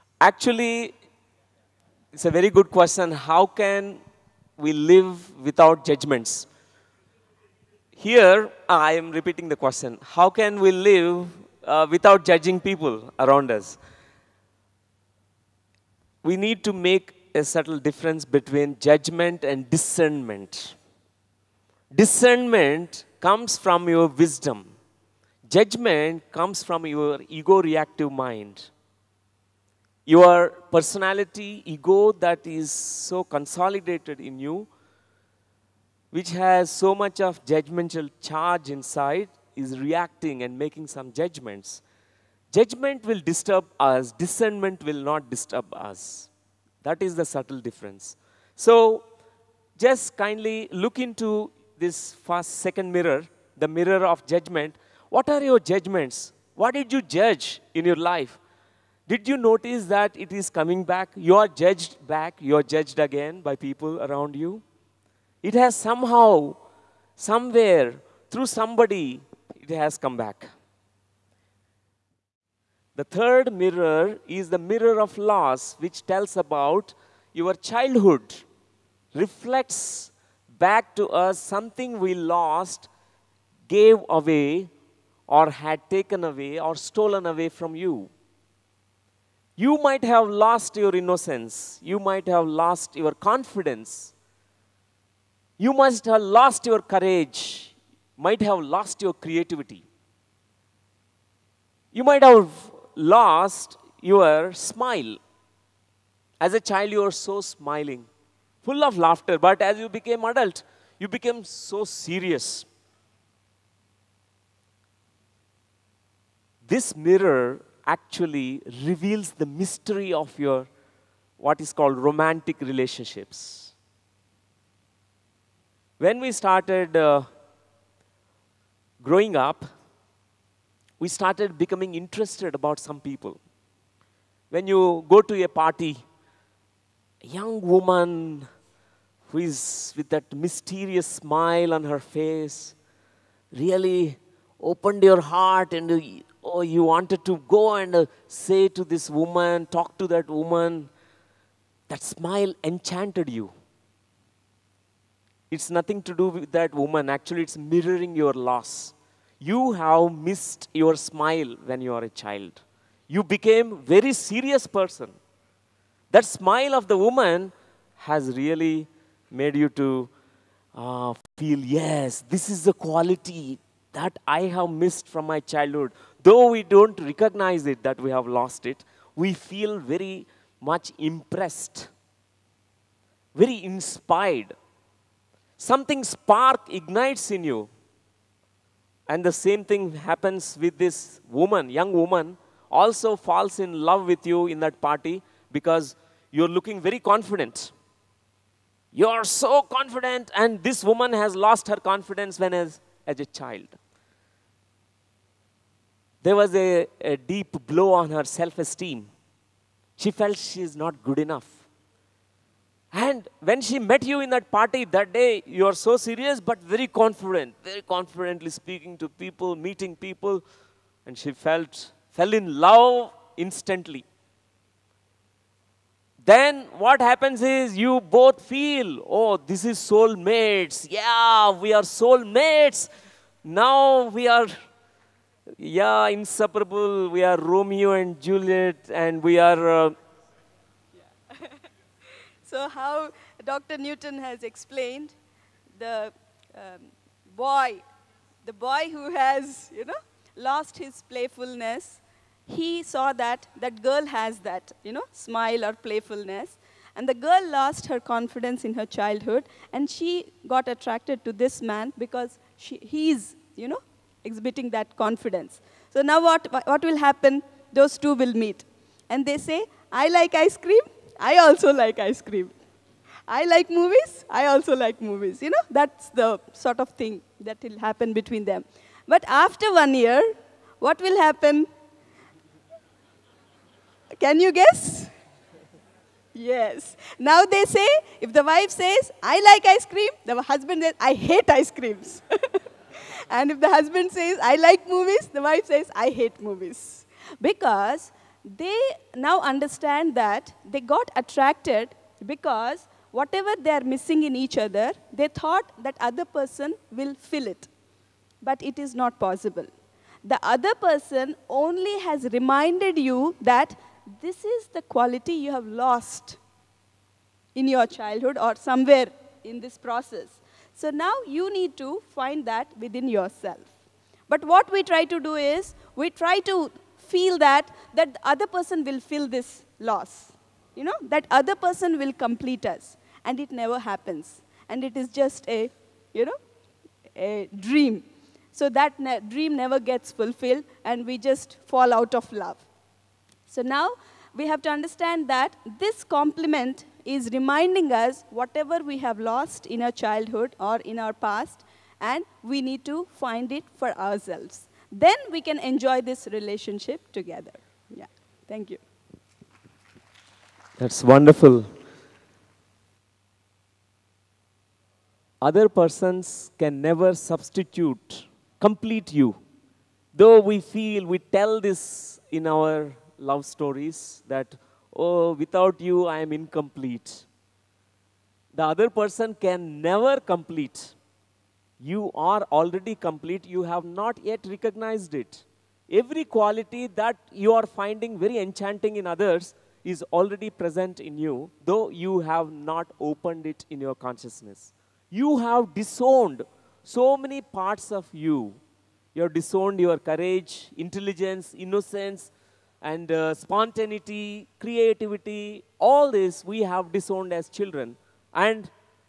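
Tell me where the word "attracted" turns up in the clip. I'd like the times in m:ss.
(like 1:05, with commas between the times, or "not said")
4:20, 5:01.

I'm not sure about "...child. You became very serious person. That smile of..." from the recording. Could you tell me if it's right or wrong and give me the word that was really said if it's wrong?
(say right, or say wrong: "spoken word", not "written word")
right.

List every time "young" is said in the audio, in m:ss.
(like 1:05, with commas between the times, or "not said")
2:17, 3:11.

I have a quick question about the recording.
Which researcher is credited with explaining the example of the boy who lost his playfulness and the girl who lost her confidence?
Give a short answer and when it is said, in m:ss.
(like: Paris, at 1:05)
Dr. Newton, at 4:03.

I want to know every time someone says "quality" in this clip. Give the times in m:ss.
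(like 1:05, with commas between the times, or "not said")
2:52, 5:14, 6:26.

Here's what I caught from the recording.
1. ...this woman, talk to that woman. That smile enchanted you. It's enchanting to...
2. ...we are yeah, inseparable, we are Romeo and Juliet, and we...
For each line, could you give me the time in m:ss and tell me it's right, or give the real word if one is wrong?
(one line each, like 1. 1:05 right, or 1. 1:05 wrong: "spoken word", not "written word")
1. 2:28 wrong: "nothing", not "enchanting"
2. 3:54 right.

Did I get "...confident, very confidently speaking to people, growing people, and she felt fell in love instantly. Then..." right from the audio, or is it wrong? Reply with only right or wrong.
wrong.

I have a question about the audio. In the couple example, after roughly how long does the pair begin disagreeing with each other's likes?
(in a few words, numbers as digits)
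1 year.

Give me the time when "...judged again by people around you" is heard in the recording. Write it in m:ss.
1:02.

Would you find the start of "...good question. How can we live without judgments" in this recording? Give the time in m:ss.
0:02.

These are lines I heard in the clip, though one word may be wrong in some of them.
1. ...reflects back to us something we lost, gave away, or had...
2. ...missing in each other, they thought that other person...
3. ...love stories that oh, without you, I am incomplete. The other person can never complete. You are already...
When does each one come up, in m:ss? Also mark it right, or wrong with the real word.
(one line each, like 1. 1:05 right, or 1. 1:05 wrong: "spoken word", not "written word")
1. 1:19 right
2. 5:03 right
3. 6:13 right.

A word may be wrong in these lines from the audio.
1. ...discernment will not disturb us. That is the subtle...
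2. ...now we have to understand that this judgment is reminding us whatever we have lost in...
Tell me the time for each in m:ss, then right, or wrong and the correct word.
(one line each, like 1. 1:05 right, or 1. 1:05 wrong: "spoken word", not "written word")
1. 0:44 right
2. 5:43 wrong: "complement", not "judgment".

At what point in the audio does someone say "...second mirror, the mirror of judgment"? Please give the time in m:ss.
0:52.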